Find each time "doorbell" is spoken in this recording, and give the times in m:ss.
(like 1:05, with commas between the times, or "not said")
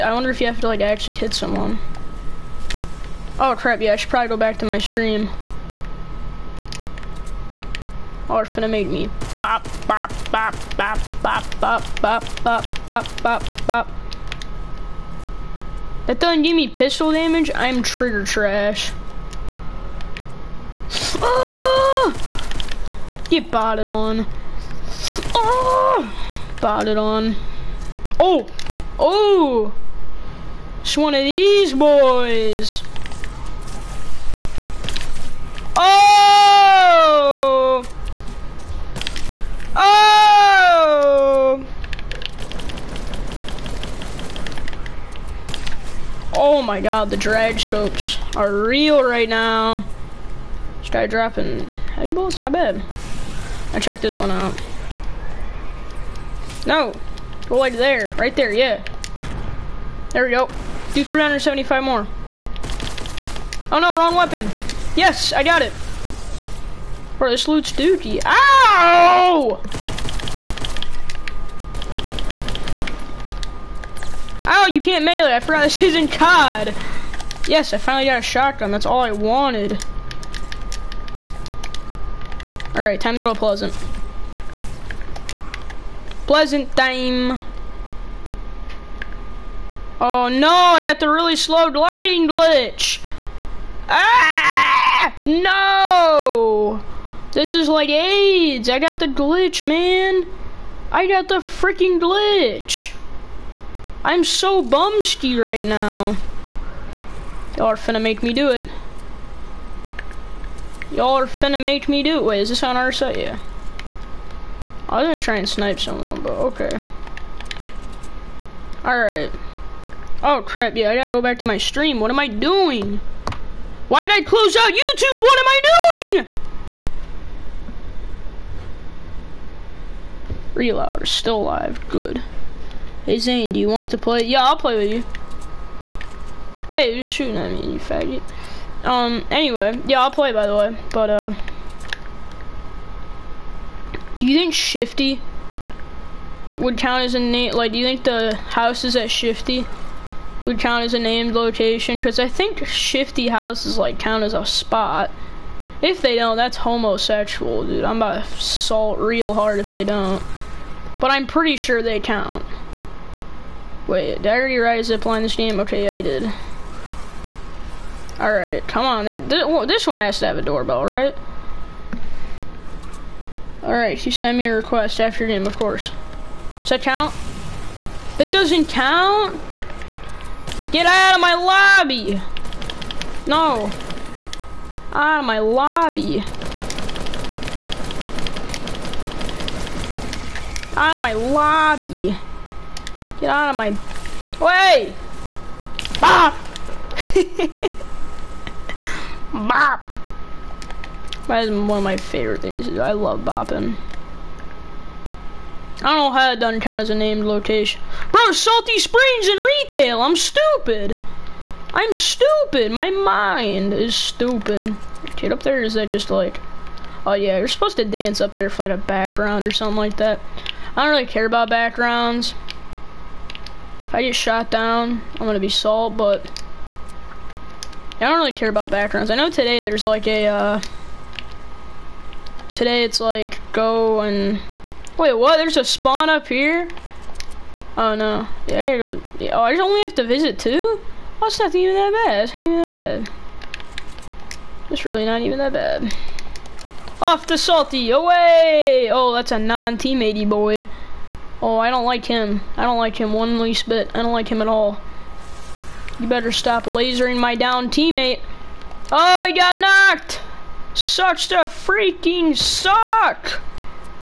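2:50.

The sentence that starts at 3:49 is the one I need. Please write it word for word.
I know today there's like a, uh, today it's like go and, wait, what?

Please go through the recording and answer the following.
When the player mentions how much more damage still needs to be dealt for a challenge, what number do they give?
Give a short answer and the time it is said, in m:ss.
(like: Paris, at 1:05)
375, at 1:01.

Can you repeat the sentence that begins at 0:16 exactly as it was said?
That doesn't give me pistol damage.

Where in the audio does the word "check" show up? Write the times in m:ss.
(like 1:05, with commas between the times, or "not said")
0:53.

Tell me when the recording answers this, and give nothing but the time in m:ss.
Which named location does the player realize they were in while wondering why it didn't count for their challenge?
3:28.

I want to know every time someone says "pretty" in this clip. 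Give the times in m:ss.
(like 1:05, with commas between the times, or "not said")
2:41.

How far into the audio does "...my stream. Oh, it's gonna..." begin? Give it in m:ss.
0:04.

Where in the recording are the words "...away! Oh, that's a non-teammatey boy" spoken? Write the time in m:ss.
4:07.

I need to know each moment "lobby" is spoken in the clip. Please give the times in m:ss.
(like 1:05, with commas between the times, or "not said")
3:01, 3:05, 3:11.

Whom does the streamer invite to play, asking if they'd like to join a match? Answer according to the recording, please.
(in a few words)
Zane.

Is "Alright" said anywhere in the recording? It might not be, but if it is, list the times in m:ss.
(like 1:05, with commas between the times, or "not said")
1:22, 1:58, 2:48, 2:53.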